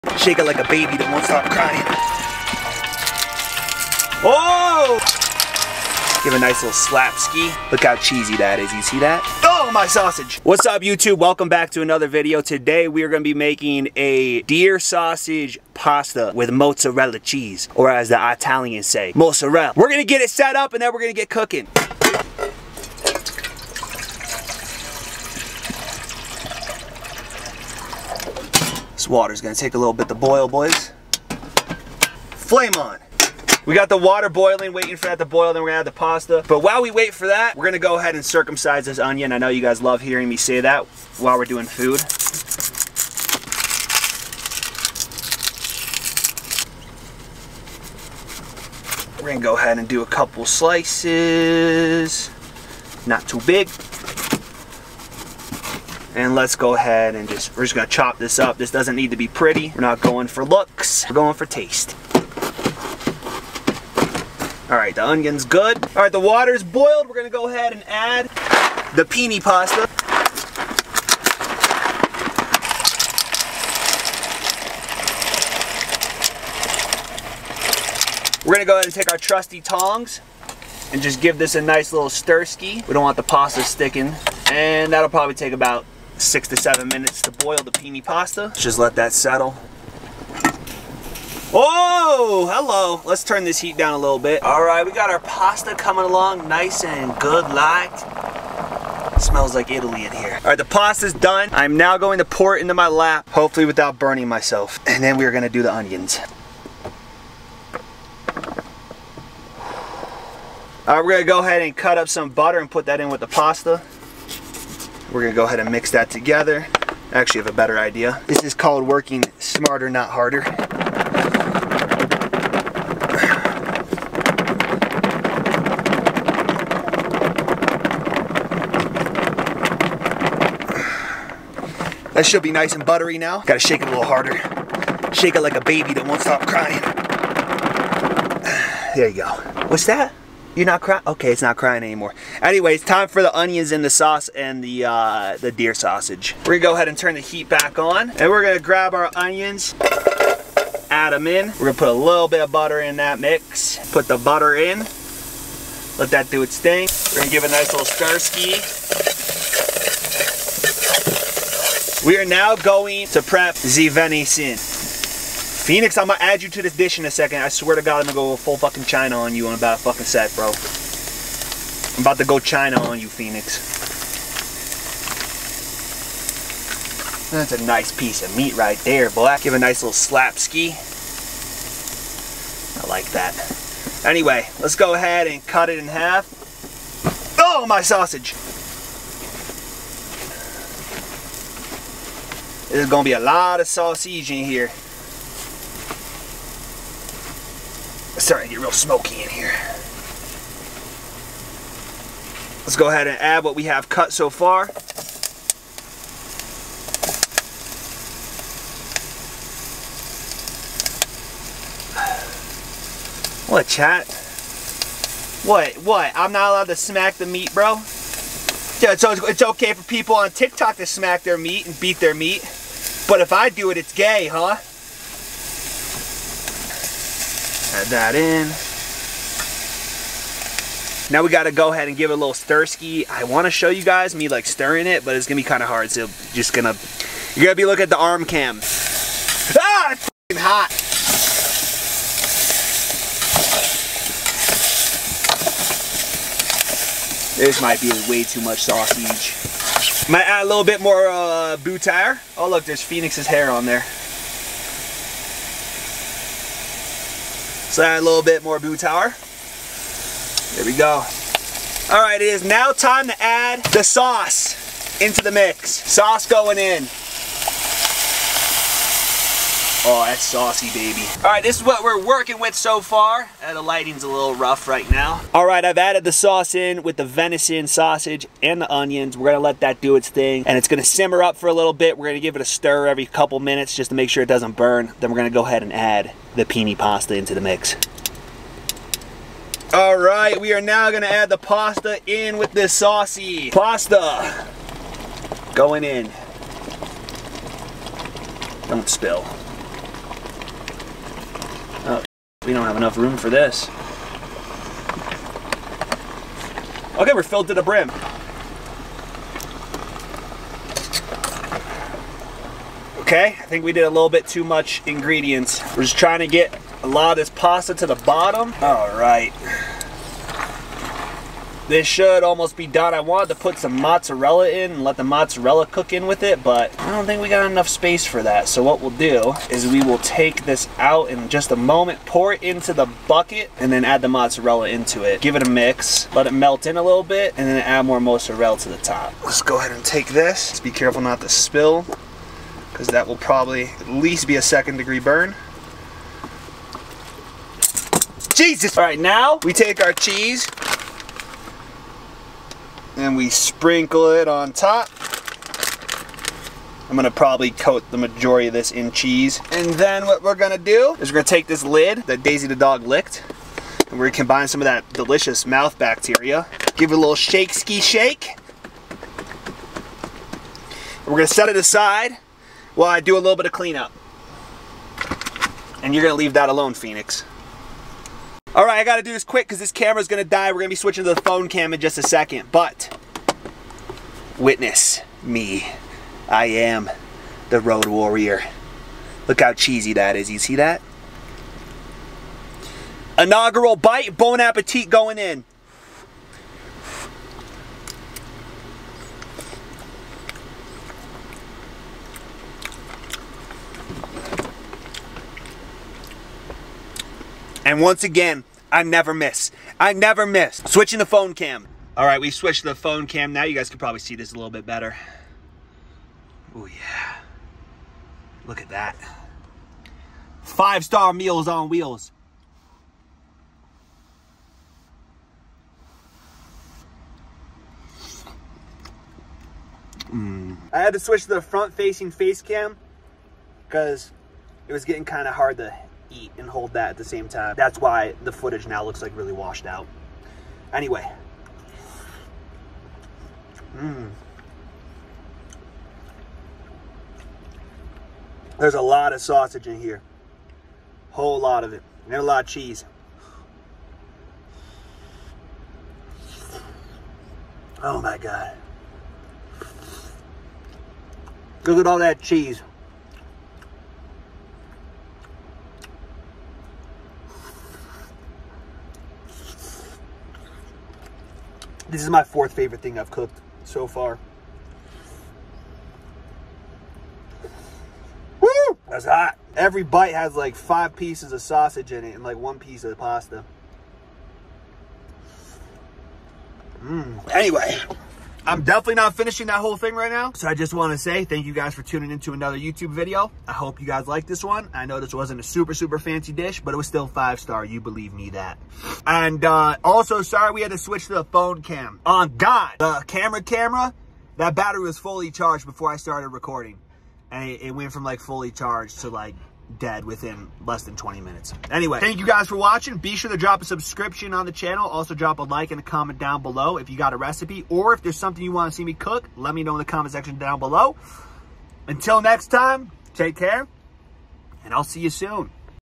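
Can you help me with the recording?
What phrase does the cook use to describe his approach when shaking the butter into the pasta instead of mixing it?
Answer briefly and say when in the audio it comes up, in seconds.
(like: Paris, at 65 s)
working smarter, not harder, at 118 s.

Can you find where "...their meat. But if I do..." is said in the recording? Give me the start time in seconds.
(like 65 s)
221 s.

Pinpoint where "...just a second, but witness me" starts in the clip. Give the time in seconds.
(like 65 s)
381 s.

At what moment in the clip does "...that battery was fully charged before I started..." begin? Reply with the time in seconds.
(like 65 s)
504 s.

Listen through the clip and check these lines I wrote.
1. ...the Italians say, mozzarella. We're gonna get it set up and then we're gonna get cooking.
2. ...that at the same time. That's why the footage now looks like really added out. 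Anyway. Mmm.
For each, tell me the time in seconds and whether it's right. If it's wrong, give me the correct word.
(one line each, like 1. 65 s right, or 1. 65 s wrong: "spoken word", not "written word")
1. 18 s right
2. 436 s wrong: "washed", not "added".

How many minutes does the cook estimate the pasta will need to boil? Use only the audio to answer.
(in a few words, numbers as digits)
6 to 7.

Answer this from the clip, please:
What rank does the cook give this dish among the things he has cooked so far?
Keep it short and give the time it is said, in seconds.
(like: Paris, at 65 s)
fourth favorite, at 472 s.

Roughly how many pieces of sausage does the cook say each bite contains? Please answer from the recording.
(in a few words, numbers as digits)
5.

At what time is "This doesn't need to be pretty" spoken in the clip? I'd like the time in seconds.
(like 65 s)
58 s.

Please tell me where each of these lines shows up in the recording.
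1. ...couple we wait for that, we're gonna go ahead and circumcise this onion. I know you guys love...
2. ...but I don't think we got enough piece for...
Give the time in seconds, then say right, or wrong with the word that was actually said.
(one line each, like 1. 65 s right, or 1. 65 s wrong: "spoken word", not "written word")
1. 36 s wrong: "while", not "couple"
2. 326 s wrong: "space", not "piece".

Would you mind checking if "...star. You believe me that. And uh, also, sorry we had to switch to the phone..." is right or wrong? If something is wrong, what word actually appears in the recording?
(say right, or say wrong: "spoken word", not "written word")
right.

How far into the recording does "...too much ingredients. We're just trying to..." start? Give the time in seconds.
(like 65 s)
314 s.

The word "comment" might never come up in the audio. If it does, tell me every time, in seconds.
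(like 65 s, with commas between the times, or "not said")
515 s, 519 s.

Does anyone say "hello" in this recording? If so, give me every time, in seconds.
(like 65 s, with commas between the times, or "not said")
92 s.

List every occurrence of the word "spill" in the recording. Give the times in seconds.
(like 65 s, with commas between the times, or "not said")
298 s, 341 s.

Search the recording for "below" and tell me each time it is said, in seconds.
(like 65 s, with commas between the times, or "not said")
516 s, 520 s.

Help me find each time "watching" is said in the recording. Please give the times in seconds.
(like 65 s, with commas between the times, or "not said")
512 s.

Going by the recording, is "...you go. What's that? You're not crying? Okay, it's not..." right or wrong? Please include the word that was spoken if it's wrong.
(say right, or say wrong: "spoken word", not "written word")
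right.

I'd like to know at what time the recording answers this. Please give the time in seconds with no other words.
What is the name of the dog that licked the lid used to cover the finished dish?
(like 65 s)
362 s.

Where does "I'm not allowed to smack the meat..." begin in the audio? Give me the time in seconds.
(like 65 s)
216 s.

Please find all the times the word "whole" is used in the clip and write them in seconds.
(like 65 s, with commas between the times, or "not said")
451 s, 489 s.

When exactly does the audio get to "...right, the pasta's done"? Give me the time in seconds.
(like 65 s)
100 s.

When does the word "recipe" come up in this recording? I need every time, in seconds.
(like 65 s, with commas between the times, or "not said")
517 s.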